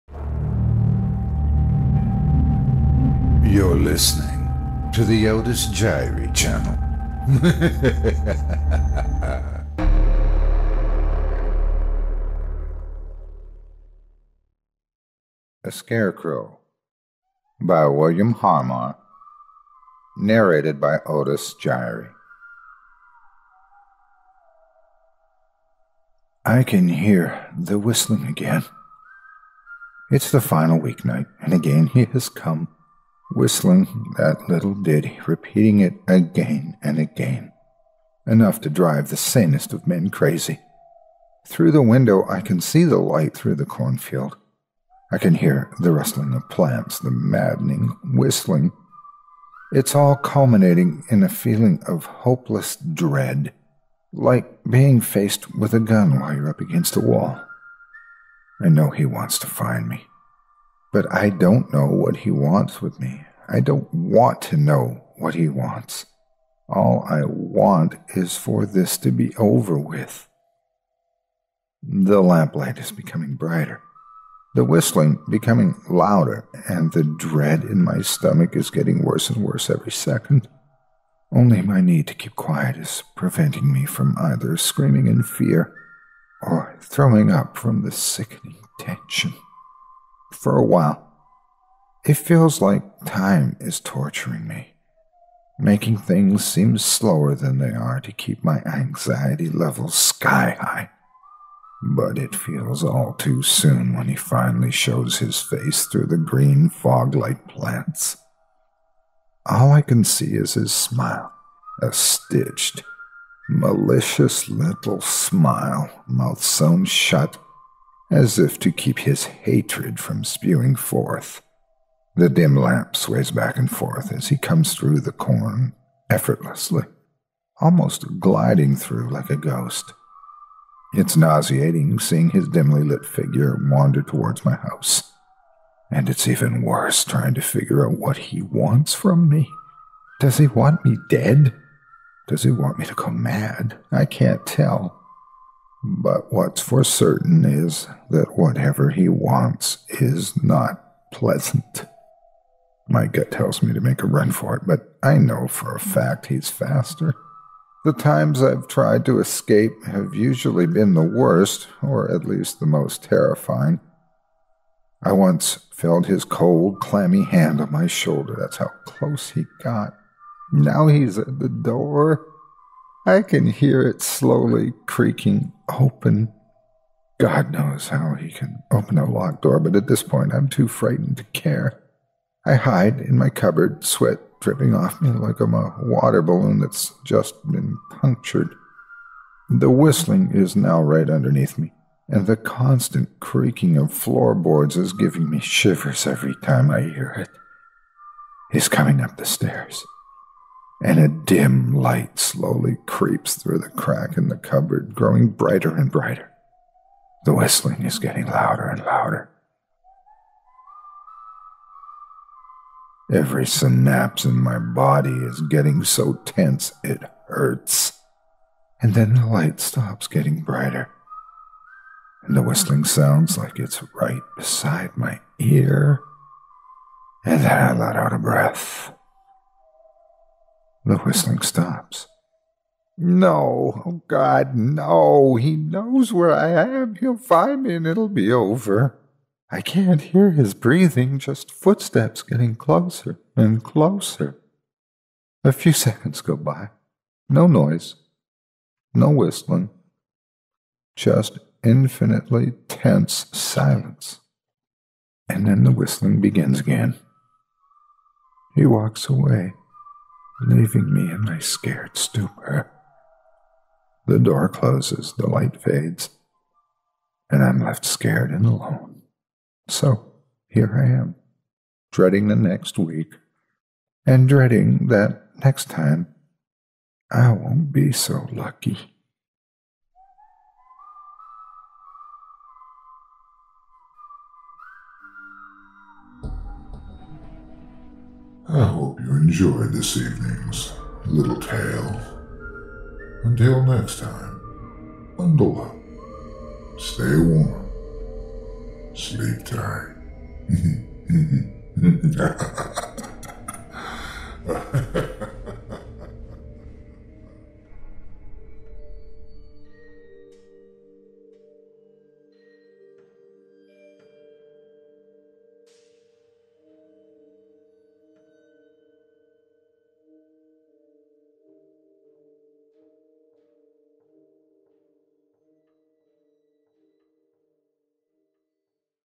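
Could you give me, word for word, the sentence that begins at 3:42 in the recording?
And the whistling sounds like it's right beside my ear.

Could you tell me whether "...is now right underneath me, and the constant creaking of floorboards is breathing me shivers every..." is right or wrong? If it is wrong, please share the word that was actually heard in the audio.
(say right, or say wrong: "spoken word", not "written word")
wrong: "giving", not "breathing".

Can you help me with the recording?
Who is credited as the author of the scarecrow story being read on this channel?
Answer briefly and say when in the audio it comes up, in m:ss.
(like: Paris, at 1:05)
William Harmar, at 0:17.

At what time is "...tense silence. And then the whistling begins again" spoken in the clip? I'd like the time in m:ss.
4:12.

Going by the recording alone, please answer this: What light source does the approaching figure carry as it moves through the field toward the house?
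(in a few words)
lamp.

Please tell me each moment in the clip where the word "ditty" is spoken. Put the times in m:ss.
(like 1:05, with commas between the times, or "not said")
0:34.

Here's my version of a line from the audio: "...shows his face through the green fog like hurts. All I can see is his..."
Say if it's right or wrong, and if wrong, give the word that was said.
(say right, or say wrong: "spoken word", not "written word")
wrong: "plants", not "hurts".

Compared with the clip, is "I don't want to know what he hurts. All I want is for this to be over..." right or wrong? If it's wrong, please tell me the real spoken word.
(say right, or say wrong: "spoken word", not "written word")
wrong: "wants", not "hurts".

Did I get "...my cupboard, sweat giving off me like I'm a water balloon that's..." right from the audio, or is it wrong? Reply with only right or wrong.
wrong.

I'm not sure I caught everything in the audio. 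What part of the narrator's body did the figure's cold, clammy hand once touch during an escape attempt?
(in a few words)
shoulder.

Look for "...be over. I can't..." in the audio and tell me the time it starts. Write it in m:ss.
3:58.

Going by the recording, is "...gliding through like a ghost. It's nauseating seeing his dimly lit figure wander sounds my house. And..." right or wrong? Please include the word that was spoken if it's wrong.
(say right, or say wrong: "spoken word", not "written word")
wrong: "towards", not "sounds".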